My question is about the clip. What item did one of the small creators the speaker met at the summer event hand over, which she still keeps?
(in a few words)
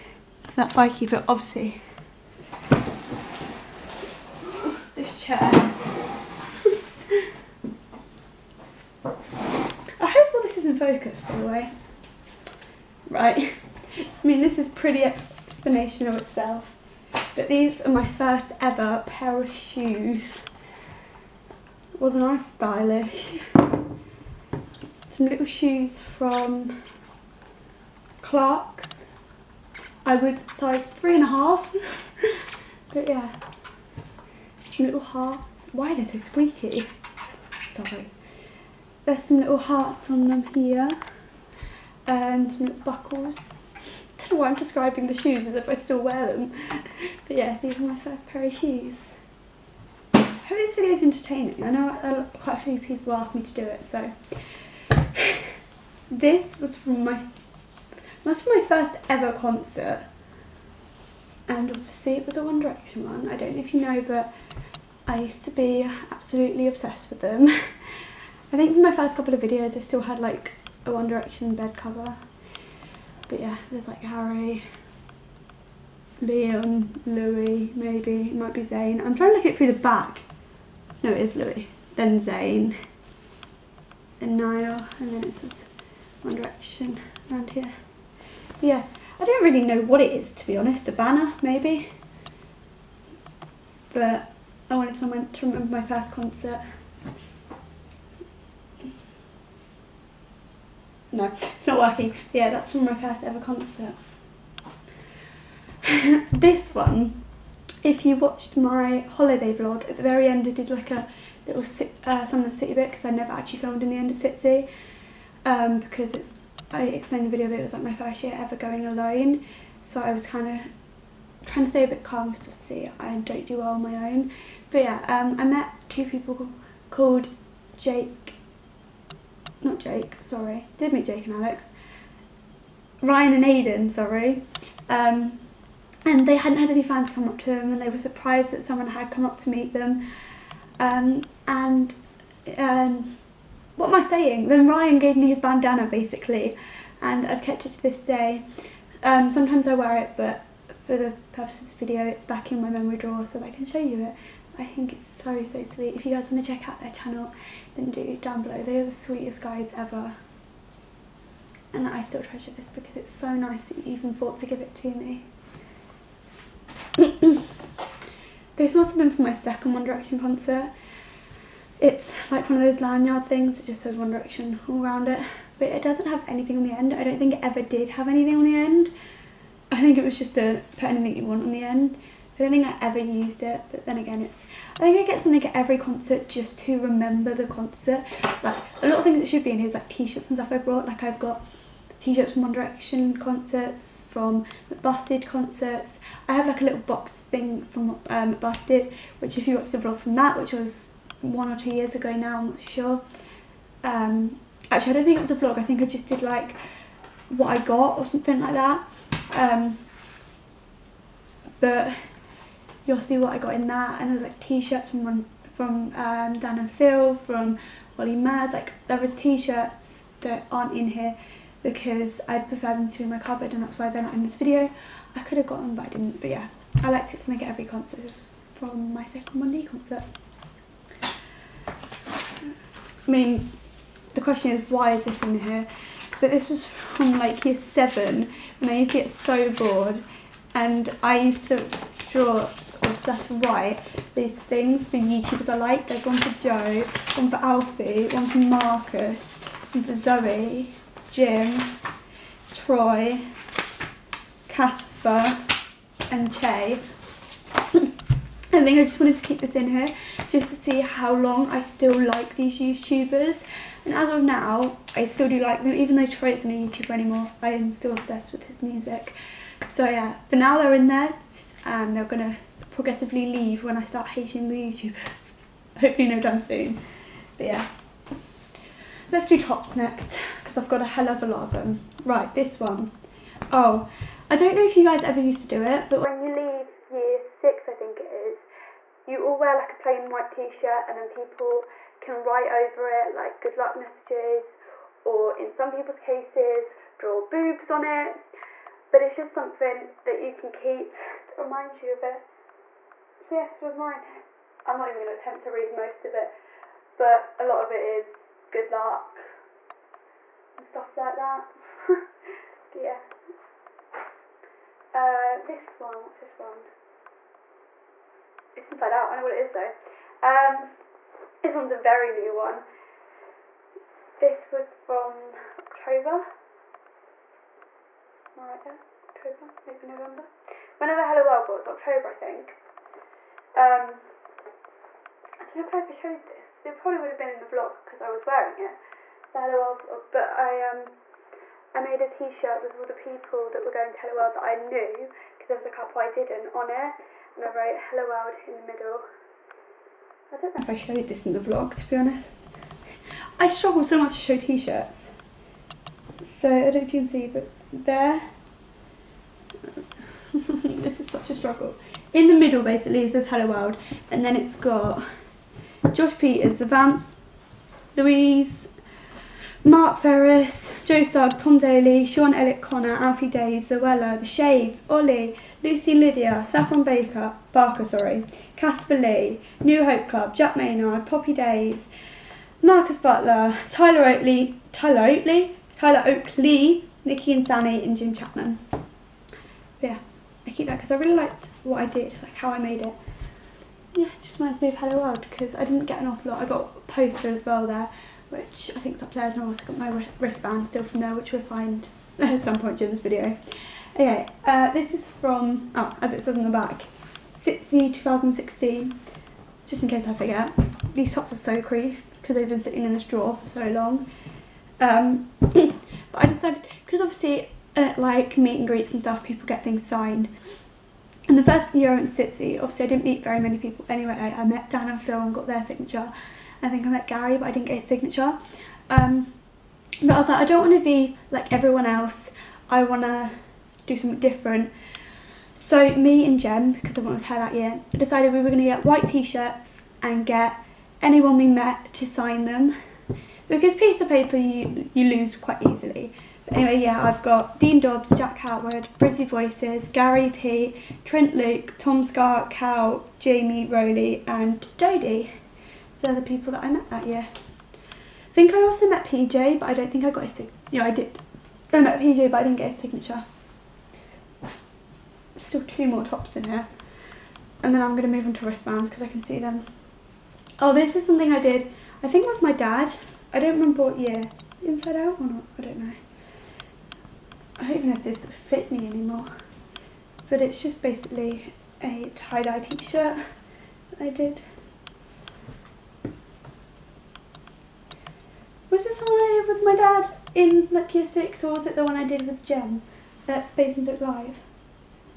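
bandana.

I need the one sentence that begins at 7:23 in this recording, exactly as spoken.
Because piece of paper you, you lose quite easily.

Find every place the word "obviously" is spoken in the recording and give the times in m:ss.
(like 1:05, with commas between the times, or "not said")
0:01, 1:01, 2:02, 6:56, 7:02.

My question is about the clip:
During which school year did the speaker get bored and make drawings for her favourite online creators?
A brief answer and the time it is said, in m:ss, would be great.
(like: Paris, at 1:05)
year seven, at 3:57.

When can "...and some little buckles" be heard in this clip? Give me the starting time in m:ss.
0:42.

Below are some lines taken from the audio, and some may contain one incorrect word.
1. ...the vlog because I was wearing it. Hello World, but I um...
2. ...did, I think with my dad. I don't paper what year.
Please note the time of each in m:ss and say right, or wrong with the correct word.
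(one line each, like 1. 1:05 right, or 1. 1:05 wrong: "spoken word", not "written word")
1. 5:37 right
2. 7:51 wrong: "remember", not "paper".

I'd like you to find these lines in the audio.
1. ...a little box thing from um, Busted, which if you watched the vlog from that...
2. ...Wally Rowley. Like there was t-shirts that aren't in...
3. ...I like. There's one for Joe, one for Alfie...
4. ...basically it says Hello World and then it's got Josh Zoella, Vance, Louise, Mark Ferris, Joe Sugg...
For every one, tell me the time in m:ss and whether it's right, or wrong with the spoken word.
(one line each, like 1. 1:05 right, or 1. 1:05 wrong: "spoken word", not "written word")
1. 3:16 right
2. 3:37 wrong: "Mads", not "Rowley"
3. 4:05 right
4. 6:02 wrong: "Pieters", not "Zoella".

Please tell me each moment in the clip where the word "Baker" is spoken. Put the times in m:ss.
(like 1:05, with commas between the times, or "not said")
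6:16.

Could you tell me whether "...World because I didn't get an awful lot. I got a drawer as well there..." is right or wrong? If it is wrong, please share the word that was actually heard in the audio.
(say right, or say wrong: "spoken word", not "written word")
wrong: "poster", not "drawer".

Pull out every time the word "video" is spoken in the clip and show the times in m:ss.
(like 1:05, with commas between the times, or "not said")
0:50, 1:09, 1:57, 2:31, 3:44, 6:43.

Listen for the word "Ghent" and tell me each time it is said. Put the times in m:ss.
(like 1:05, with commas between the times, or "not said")
not said.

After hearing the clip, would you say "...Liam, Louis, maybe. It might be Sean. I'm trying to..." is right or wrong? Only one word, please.
wrong.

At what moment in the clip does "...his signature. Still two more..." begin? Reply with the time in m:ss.
7:42.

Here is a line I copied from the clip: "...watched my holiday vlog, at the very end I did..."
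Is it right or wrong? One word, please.
right.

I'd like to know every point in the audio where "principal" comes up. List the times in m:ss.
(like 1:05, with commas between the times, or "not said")
not said.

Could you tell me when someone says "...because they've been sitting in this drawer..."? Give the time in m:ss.
6:52.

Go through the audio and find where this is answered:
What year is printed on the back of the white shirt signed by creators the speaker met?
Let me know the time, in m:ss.
6:47.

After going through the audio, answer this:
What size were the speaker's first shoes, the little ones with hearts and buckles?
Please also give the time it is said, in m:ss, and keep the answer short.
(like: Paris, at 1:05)
3.5, at 0:30.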